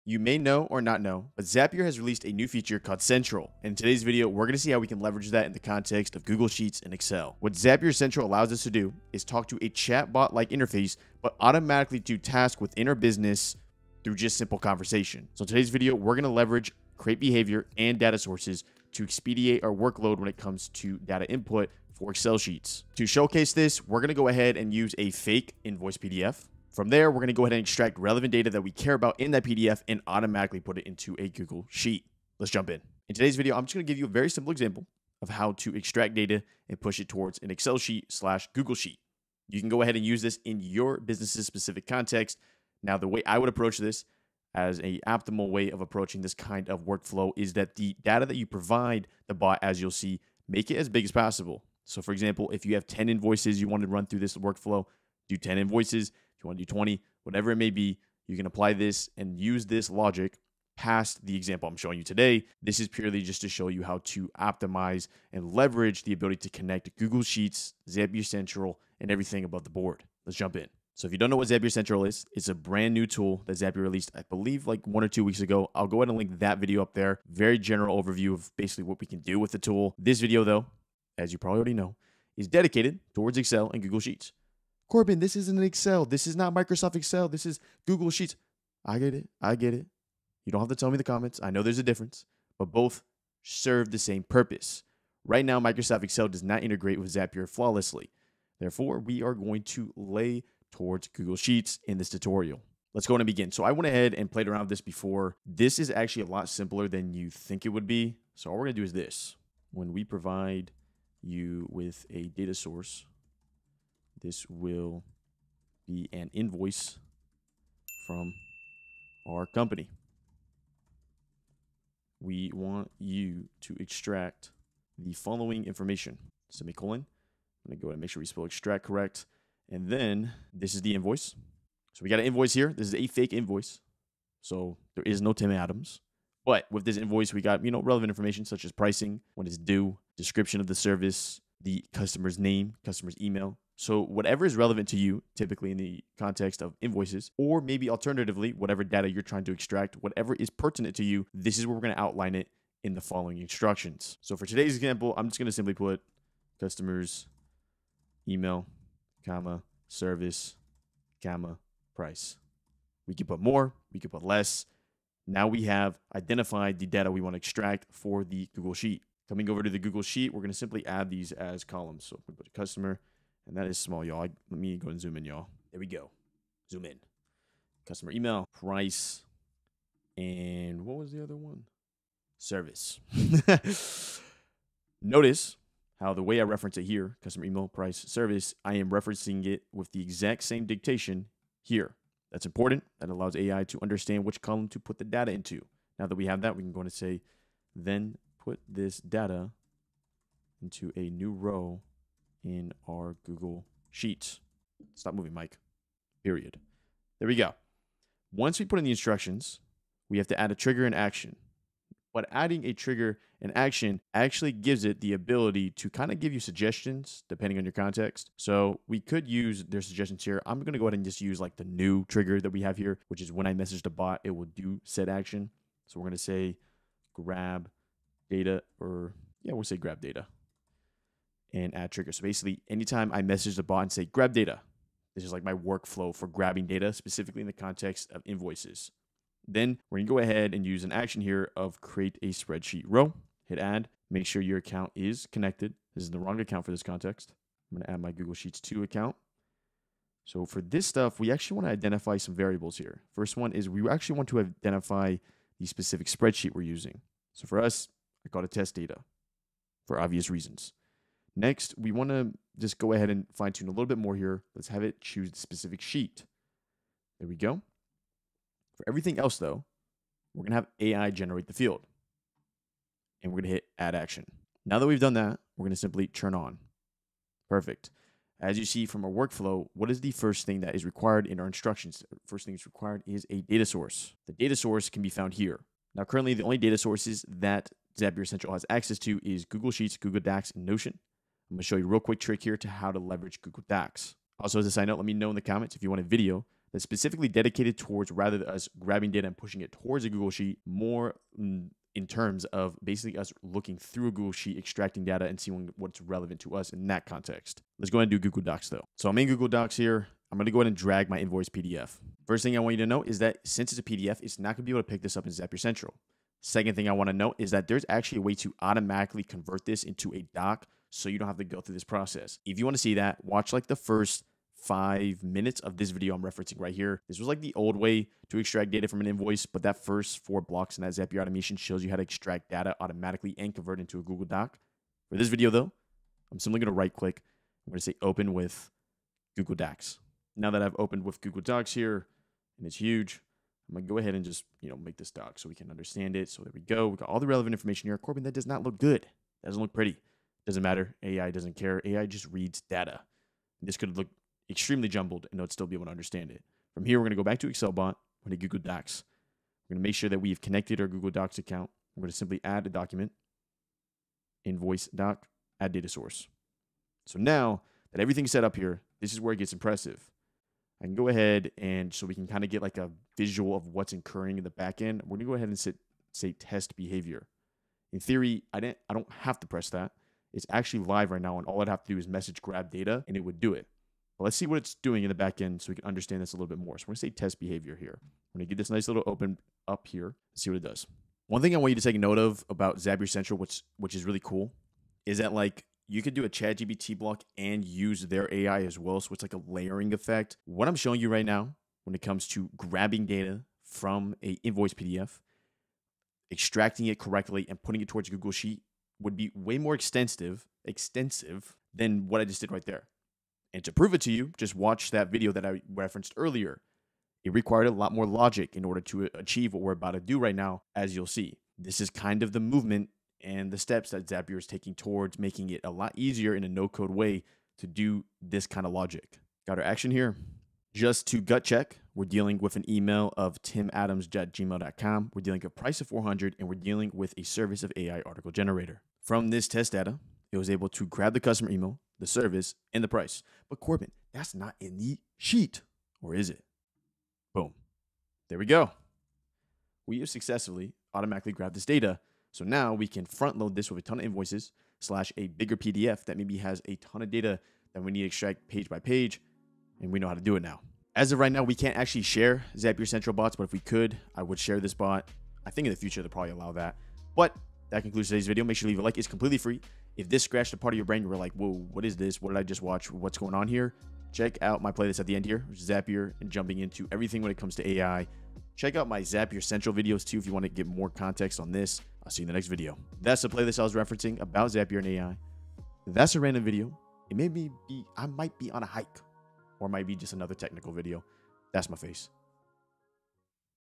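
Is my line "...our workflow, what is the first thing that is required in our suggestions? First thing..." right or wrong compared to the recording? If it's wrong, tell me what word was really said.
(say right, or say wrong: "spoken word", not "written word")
wrong: "instructions", not "suggestions".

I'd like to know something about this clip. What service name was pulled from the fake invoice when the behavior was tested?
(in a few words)
AI article generator.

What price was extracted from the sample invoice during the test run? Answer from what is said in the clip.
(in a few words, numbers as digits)
400.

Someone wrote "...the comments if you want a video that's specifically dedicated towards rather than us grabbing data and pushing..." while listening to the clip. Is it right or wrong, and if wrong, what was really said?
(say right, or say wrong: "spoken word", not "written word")
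right.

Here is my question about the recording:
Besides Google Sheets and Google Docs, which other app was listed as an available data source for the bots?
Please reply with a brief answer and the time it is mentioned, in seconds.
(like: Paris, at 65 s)
Notion, at 290 s.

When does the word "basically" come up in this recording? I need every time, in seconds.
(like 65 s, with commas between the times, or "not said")
78 s, 232 s, 302 s.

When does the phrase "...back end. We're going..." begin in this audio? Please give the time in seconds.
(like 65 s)
374 s.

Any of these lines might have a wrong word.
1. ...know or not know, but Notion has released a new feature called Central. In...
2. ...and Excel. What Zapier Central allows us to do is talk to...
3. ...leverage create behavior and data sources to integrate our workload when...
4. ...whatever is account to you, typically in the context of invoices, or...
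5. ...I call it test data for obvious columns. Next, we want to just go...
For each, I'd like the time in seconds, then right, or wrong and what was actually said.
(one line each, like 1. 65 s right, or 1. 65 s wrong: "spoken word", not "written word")
1. 0 s wrong: "Zapier", not "Notion"
2. 6 s right
3. 16 s wrong: "expedite", not "integrate"
4. 144 s wrong: "relevant", not "account"
5. 258 s wrong: "reasons", not "columns".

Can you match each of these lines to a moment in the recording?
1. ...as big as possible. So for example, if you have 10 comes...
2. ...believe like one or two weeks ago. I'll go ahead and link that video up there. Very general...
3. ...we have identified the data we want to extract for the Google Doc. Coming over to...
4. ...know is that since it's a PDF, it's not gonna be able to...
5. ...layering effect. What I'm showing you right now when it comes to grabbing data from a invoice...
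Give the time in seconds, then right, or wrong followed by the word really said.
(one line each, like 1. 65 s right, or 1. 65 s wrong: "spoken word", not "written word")
1. 50 s wrong: "invoices", not "comes"
2. 74 s right
3. 165 s wrong: "Sheet", not "Doc"
4. 312 s right
5. 399 s right.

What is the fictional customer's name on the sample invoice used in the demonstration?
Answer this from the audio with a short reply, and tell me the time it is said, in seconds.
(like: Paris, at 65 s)
Tim Adams, at 135 s.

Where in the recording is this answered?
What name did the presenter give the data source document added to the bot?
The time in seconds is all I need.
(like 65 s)
364 s.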